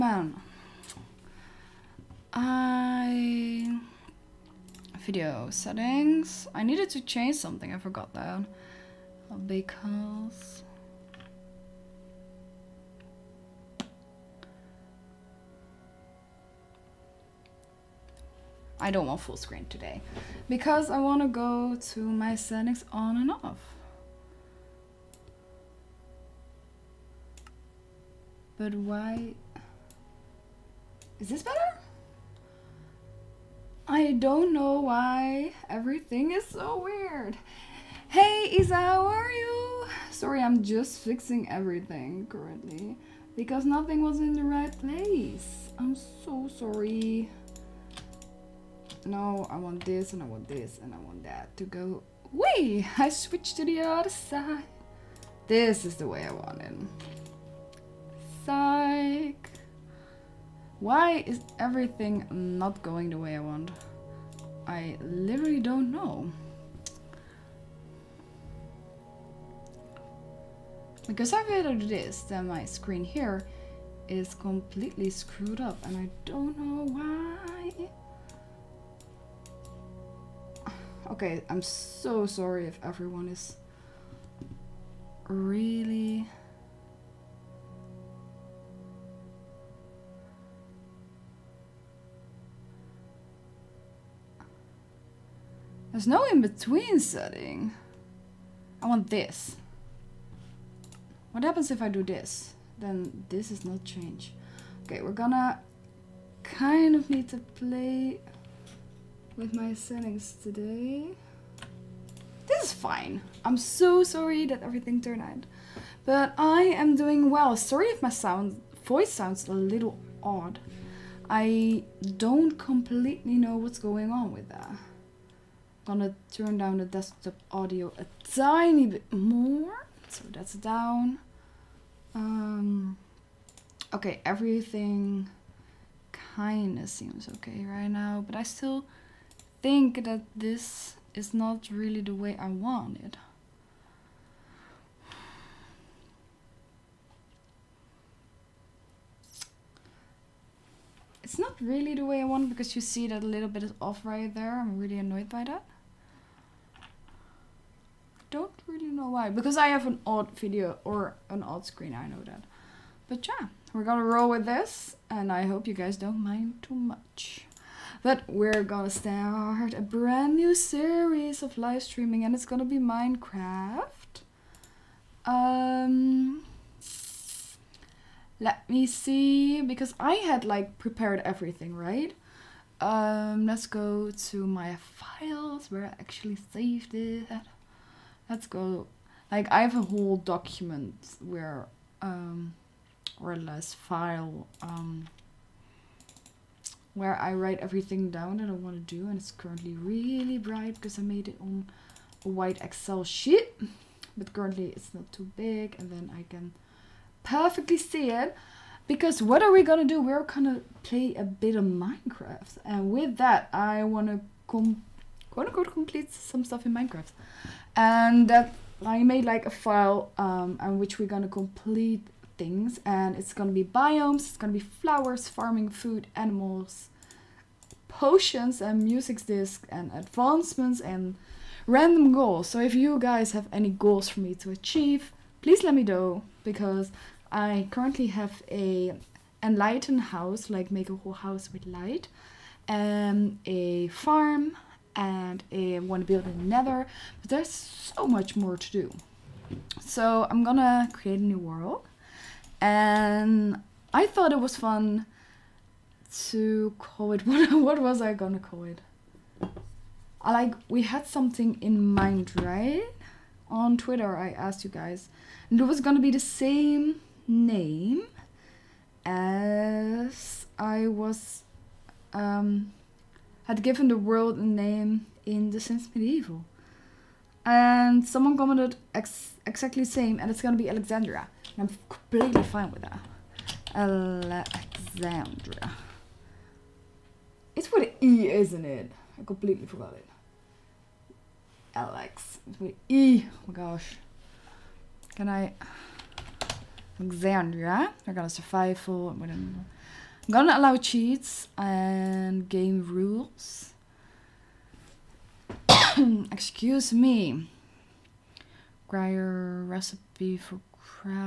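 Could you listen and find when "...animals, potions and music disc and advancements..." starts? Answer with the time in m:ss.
3:46.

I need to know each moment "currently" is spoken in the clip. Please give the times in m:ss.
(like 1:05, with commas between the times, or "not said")
0:42, 3:19, 3:24, 3:57.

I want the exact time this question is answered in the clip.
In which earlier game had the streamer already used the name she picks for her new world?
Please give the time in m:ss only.
4:35.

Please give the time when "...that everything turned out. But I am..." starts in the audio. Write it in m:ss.
1:54.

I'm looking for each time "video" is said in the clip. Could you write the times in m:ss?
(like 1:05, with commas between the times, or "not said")
0:04, 2:40.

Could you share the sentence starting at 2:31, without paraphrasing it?
It's not really the way I want because you see that a little bit is off right there.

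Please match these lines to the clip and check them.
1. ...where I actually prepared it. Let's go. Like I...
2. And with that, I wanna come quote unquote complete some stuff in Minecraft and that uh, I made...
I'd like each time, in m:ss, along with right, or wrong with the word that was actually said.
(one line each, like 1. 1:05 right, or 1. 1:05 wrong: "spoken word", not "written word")
1. 3:05 wrong: "saved", not "prepared"
2. 3:32 right.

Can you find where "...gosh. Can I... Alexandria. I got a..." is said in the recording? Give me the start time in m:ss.
4:53.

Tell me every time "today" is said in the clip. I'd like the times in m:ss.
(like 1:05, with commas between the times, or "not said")
0:19, 1:50.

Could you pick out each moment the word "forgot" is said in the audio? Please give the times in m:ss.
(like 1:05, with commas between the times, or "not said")
0:07, 4:49.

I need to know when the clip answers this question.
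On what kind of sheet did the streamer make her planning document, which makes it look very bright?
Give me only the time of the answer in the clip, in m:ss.
3:22.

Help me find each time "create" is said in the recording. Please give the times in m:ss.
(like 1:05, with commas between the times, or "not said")
4:10.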